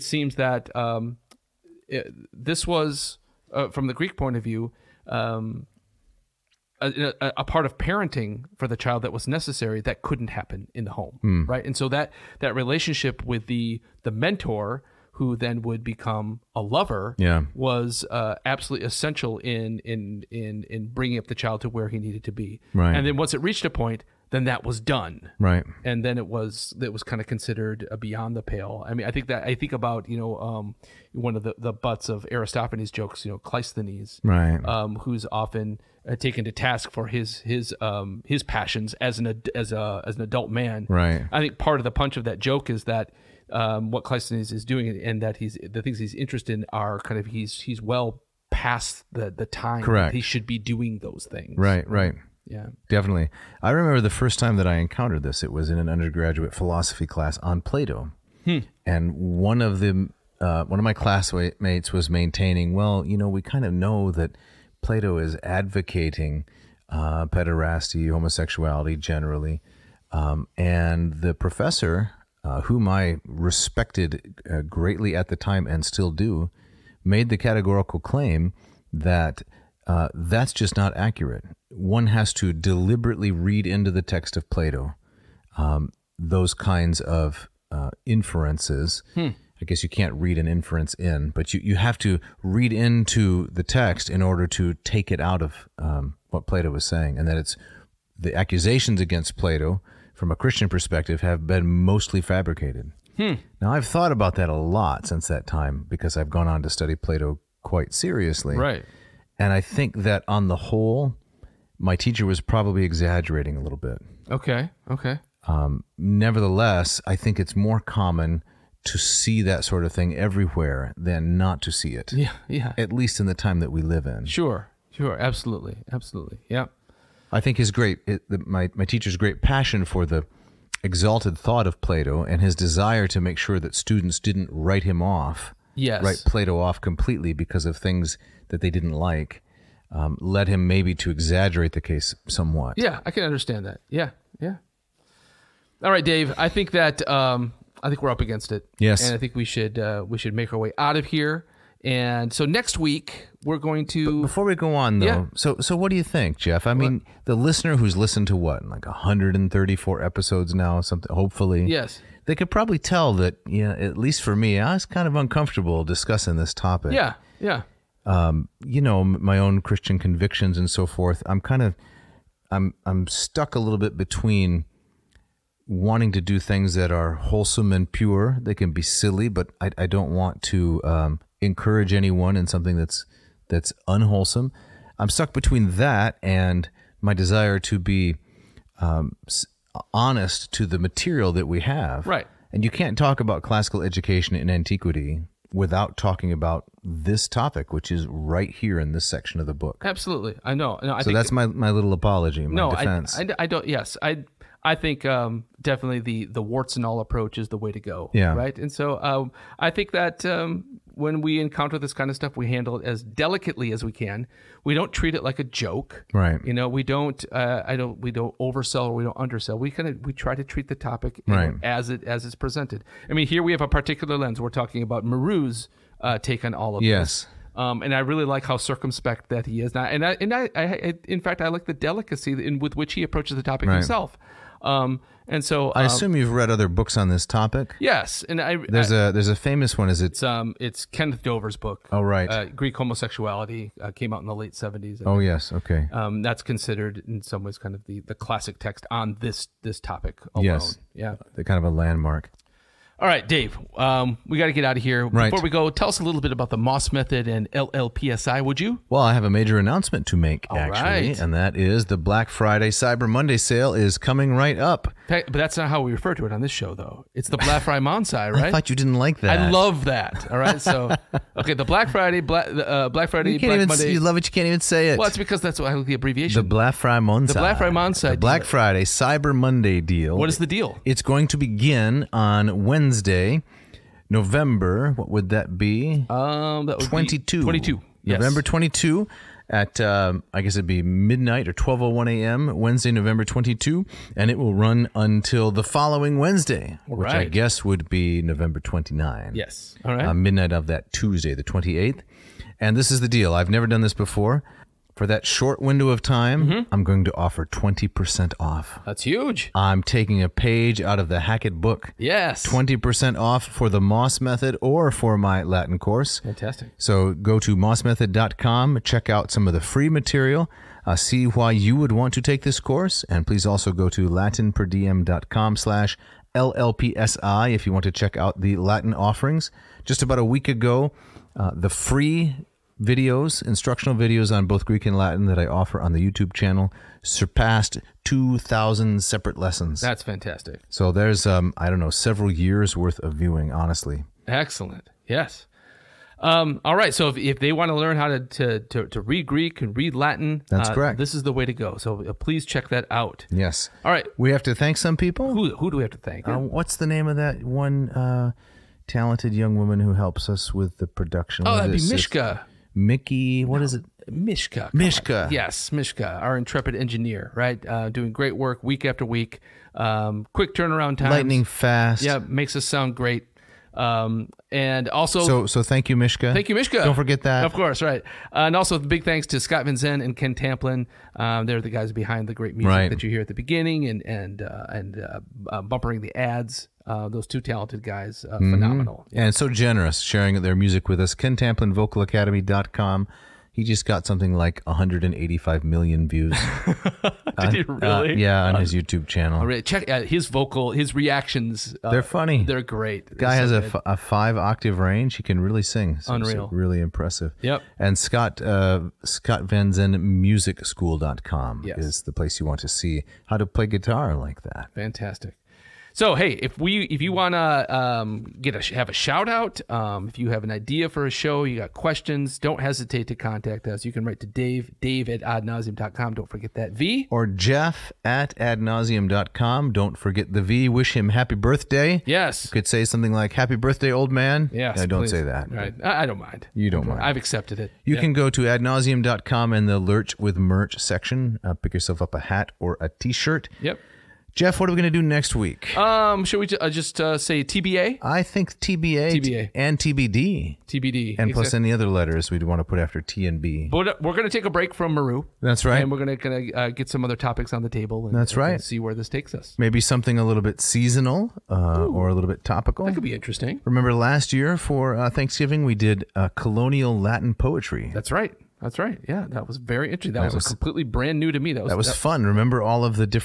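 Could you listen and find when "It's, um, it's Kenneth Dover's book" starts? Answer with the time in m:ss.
4:00.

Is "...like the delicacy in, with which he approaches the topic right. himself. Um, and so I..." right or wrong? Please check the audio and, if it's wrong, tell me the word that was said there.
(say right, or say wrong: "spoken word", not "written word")
right.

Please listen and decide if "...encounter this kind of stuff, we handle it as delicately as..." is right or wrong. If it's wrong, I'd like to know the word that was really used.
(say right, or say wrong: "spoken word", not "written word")
right.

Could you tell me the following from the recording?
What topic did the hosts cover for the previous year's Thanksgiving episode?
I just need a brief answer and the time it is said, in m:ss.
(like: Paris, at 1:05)
colonial Latin poetry, at 7:46.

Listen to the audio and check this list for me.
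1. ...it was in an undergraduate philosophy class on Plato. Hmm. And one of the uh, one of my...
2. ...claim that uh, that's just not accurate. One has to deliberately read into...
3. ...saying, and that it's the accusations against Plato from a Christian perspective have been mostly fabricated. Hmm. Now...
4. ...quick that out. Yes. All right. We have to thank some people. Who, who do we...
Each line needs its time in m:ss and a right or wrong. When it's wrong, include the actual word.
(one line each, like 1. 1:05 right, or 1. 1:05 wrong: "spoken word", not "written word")
1. 0:55 right
2. 1:17 right
3. 1:36 right
4. 5:52 wrong: "check", not "quick".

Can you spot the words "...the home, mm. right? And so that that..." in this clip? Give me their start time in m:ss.
0:10.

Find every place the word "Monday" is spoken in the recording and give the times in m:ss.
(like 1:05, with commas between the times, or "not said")
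4:23, 4:33, 4:39.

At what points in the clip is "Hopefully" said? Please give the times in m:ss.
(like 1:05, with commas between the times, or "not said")
2:41.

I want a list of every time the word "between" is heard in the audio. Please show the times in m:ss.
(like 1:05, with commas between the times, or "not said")
2:53, 3:05.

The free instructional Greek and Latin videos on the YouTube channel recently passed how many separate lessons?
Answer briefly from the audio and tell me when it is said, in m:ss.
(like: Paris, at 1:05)
2,000, at 5:38.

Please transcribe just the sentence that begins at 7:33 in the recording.
But uh, we're going to take a break from Marrou.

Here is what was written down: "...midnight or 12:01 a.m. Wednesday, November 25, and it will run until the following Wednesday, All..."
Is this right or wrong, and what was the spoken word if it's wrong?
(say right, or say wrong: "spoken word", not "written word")
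wrong: "22", not "25".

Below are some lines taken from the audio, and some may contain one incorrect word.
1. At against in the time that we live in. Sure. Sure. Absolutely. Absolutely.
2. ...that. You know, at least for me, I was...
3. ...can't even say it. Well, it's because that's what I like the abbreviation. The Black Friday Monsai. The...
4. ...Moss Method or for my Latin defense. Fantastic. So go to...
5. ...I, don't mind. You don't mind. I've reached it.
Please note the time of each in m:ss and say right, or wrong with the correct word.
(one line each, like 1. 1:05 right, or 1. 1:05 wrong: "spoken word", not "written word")
1. 2:02 wrong: "least", not "against"
2. 2:43 right
3. 4:34 right
4. 5:13 wrong: "course", not "defense"
5. 7:16 wrong: "accepted", not "reached".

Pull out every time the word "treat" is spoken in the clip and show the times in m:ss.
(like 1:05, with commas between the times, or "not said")
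3:34, 3:40.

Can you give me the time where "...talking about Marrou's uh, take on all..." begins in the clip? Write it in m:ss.
3:44.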